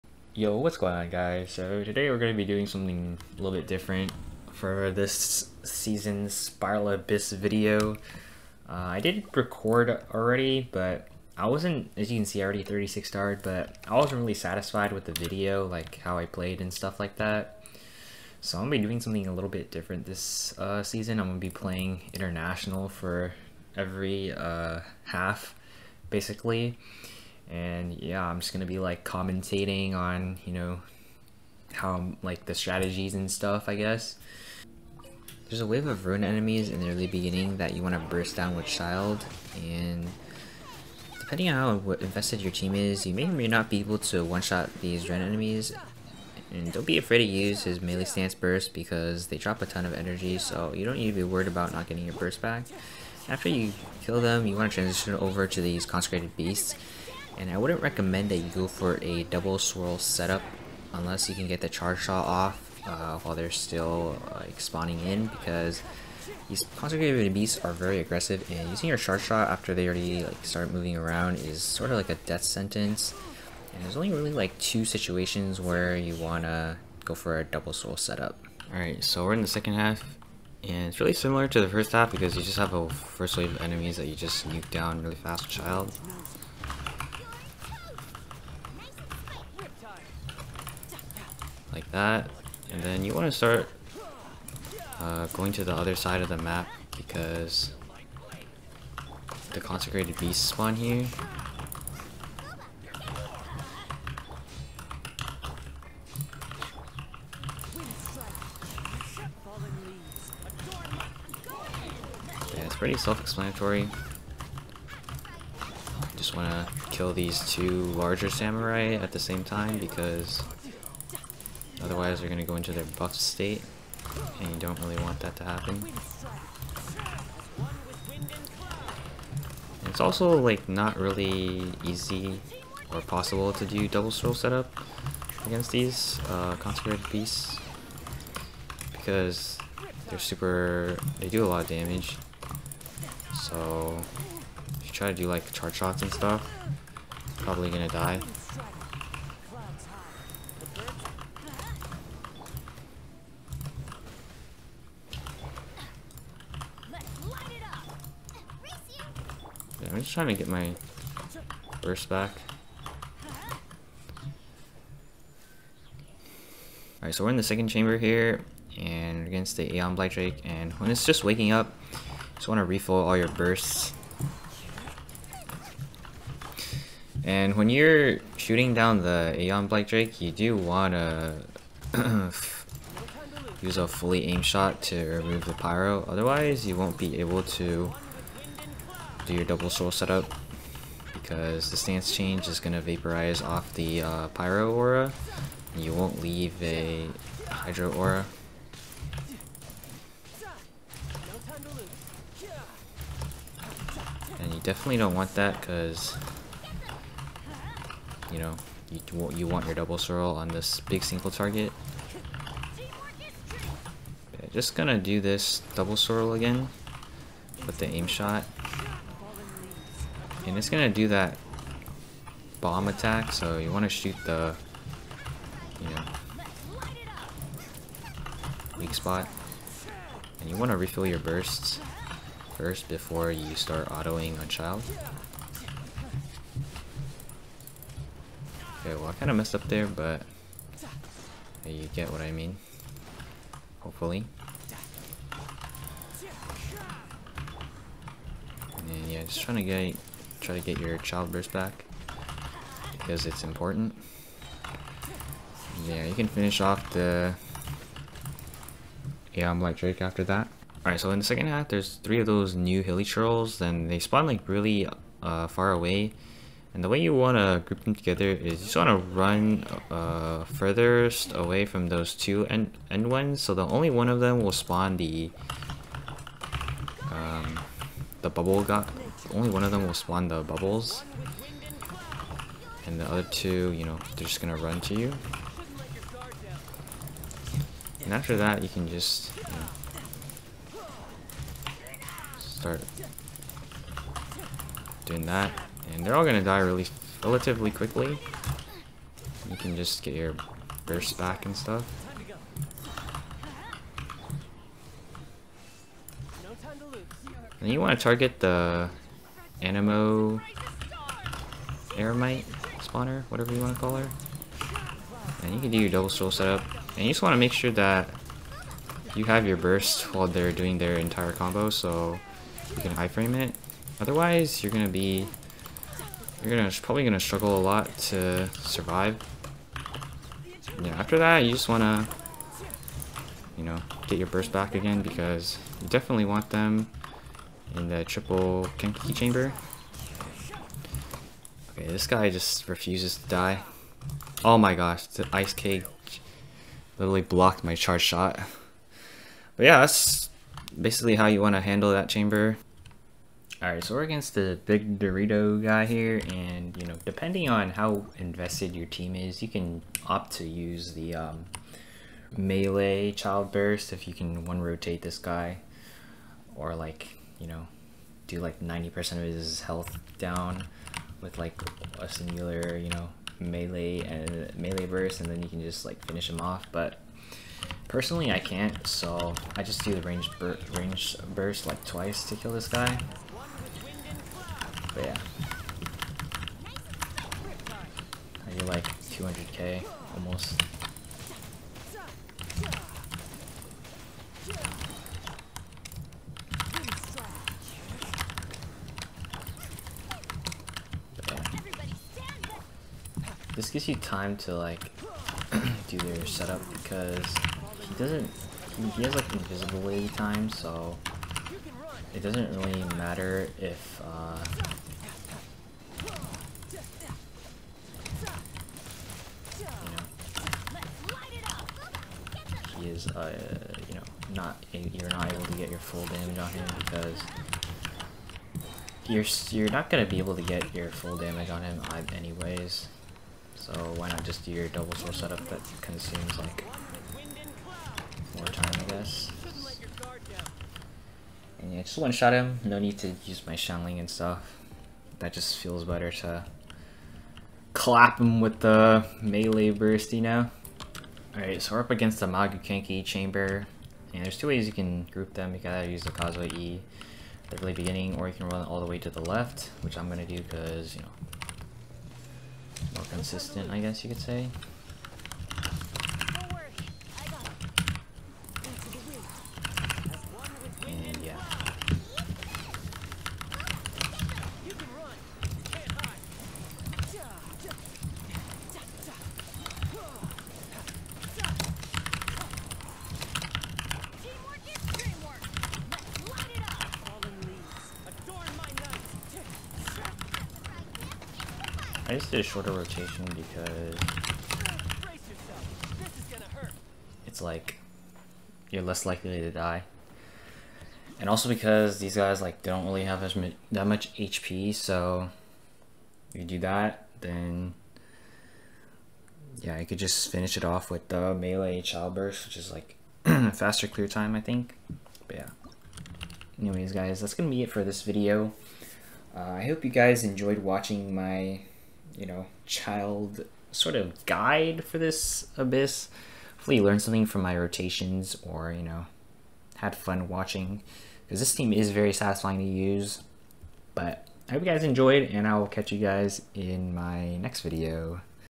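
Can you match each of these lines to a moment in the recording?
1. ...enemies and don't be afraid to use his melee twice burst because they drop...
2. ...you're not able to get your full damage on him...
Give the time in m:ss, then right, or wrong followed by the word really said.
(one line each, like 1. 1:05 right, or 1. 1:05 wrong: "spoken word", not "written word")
1. 0:45 wrong: "stance", not "twice"
2. 7:04 right.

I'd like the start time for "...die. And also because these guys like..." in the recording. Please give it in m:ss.
8:19.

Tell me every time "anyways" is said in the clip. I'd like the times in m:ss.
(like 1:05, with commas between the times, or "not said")
7:12, 8:36.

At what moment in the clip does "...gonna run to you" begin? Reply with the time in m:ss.
4:44.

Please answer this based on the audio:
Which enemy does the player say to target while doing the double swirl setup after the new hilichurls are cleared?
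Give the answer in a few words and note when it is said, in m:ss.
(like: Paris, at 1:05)
Anemo Eremite spawner, at 5:09.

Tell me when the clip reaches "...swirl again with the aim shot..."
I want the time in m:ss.
3:35.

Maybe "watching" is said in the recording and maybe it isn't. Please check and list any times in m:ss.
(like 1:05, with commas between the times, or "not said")
8:40, 8:50.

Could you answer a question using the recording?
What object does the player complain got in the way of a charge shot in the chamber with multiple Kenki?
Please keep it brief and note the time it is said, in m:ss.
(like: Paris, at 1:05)
ice cake, at 5:45.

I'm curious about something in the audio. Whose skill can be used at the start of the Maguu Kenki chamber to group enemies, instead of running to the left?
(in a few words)
Kazuha.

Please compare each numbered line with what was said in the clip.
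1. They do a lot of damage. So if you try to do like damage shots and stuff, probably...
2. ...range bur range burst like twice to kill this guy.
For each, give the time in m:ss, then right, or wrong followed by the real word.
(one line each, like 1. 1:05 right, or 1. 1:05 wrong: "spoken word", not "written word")
1. 2:21 wrong: "charge", not "damage"
2. 6:20 right.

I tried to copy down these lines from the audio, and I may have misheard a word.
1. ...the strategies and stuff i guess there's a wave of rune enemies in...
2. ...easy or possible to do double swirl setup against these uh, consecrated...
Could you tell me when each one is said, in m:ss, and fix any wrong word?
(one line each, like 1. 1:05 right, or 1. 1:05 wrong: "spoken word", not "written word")
1. 0:32 right
2. 2:11 right.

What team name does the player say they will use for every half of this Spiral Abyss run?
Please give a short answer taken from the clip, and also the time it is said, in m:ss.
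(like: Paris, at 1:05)
International, at 0:22.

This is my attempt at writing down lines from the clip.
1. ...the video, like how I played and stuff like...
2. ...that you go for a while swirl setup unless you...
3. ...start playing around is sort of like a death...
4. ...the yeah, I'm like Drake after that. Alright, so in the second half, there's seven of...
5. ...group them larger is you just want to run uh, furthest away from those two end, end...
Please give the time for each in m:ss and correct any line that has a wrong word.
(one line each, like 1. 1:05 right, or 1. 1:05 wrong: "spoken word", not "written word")
1. 0:15 right
2. 0:58 wrong: "double", not "while"
3. 1:10 wrong: "moving", not "playing"
4. 4:16 wrong: "three", not "seven"
5. 4:27 wrong: "together", not "larger".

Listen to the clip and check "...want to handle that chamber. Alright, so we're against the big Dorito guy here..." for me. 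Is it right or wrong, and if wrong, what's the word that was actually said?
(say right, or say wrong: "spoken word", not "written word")
right.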